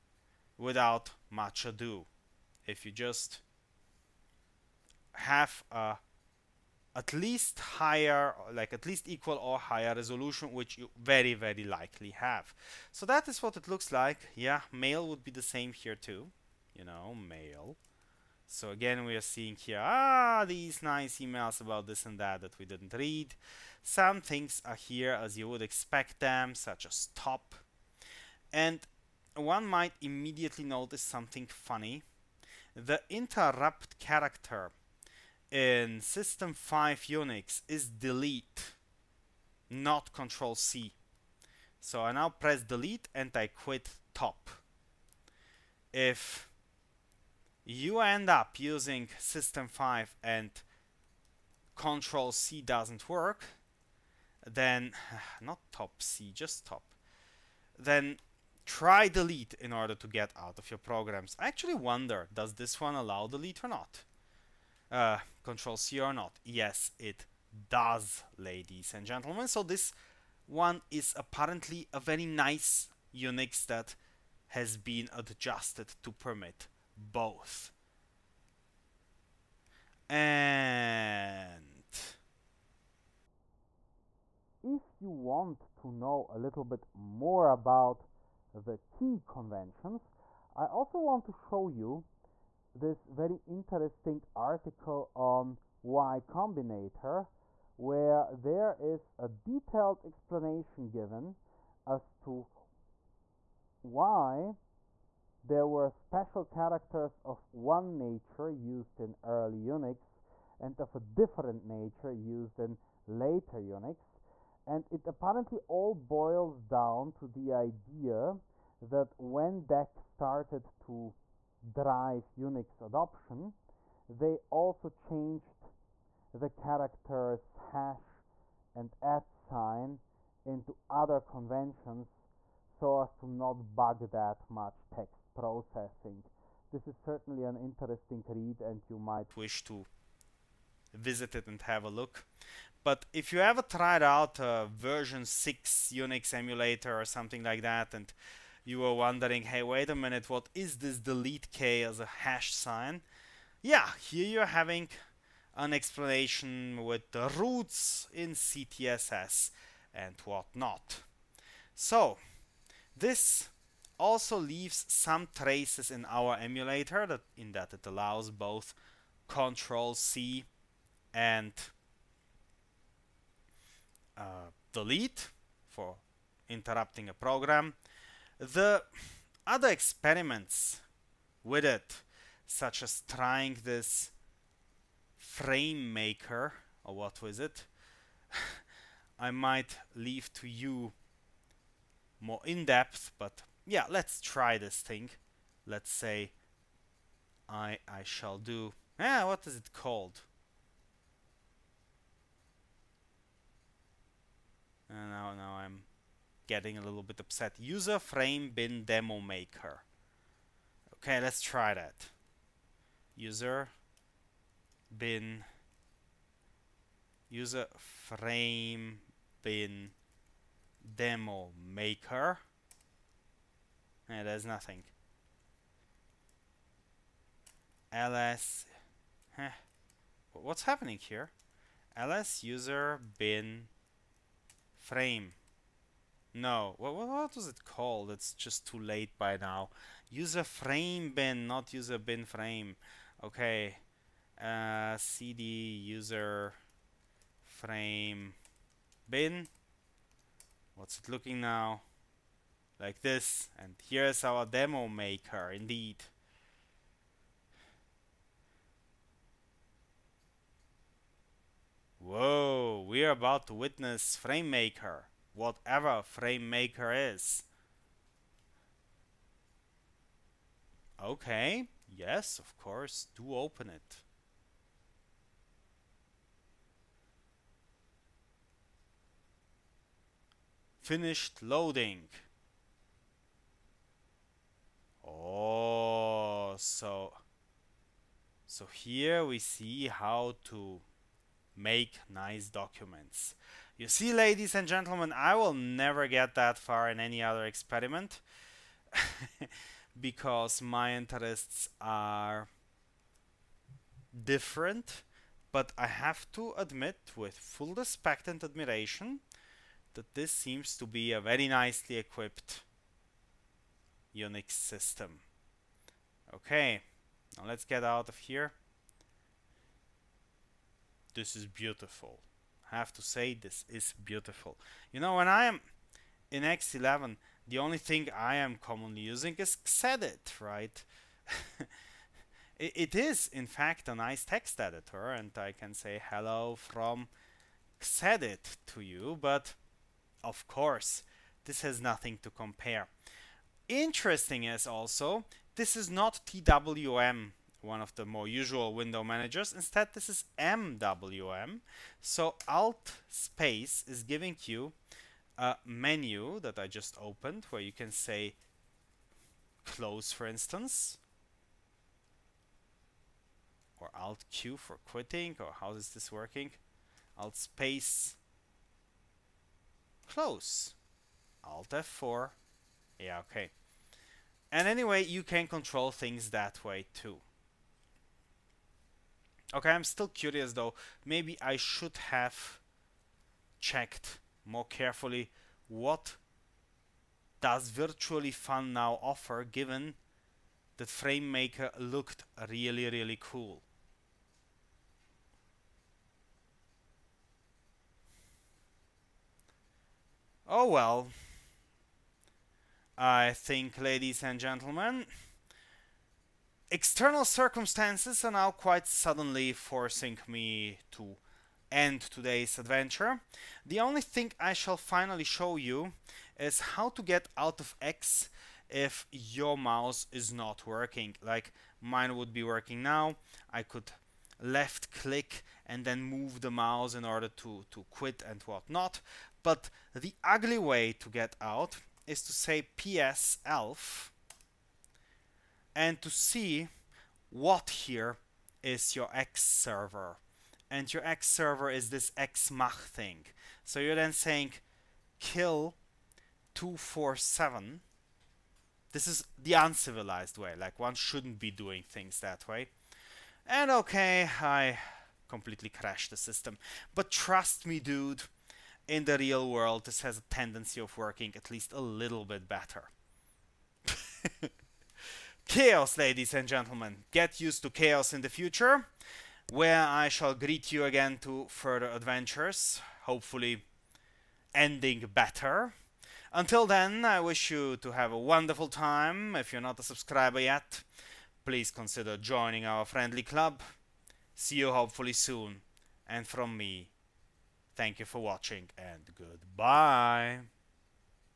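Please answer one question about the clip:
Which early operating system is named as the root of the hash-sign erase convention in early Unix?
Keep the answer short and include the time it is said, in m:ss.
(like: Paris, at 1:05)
CTSS, at 2:38.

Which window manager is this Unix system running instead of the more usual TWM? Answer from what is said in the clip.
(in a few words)
MWM.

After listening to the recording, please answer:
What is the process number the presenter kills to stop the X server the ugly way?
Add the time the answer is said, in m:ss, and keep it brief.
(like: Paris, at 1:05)
247, at 7:26.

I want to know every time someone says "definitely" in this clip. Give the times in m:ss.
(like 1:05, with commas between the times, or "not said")
not said.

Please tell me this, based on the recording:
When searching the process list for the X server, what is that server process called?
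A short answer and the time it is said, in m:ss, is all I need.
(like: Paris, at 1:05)
X Mach, at 7:22.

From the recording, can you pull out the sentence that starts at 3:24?
Uh, now now I'm getting a little bit upset.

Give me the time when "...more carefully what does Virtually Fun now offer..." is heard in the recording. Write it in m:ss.
6:24.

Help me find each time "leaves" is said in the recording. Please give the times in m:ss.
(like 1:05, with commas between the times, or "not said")
2:44, 3:09.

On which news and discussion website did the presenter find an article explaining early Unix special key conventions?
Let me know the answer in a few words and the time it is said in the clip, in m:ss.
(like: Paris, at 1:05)
Y Combinator, at 1:35.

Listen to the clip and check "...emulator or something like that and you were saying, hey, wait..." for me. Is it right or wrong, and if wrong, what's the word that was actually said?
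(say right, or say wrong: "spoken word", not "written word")
wrong: "wondering", not "saying".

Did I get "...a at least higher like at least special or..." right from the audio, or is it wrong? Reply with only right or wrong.
wrong.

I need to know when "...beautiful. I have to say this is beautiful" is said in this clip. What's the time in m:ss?
5:21.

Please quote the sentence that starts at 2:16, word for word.
This is certainly an interesting read and you might wish to visit it and have a look.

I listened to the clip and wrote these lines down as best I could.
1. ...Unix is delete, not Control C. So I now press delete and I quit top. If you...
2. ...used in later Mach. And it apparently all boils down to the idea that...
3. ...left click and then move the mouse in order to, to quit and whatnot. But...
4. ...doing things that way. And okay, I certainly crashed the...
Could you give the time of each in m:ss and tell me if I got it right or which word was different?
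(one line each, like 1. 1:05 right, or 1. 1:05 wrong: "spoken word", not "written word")
1. 0:37 right
2. 1:52 wrong: "Unix", not "Mach"
3. 7:04 right
4. 7:31 wrong: "completely", not "certainly".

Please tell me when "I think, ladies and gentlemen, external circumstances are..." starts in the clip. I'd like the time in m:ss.
6:42.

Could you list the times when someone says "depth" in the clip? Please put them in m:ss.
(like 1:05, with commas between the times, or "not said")
3:12.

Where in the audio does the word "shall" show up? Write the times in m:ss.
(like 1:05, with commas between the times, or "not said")
3:18, 6:54, 7:50.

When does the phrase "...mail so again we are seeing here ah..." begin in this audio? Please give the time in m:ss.
0:17.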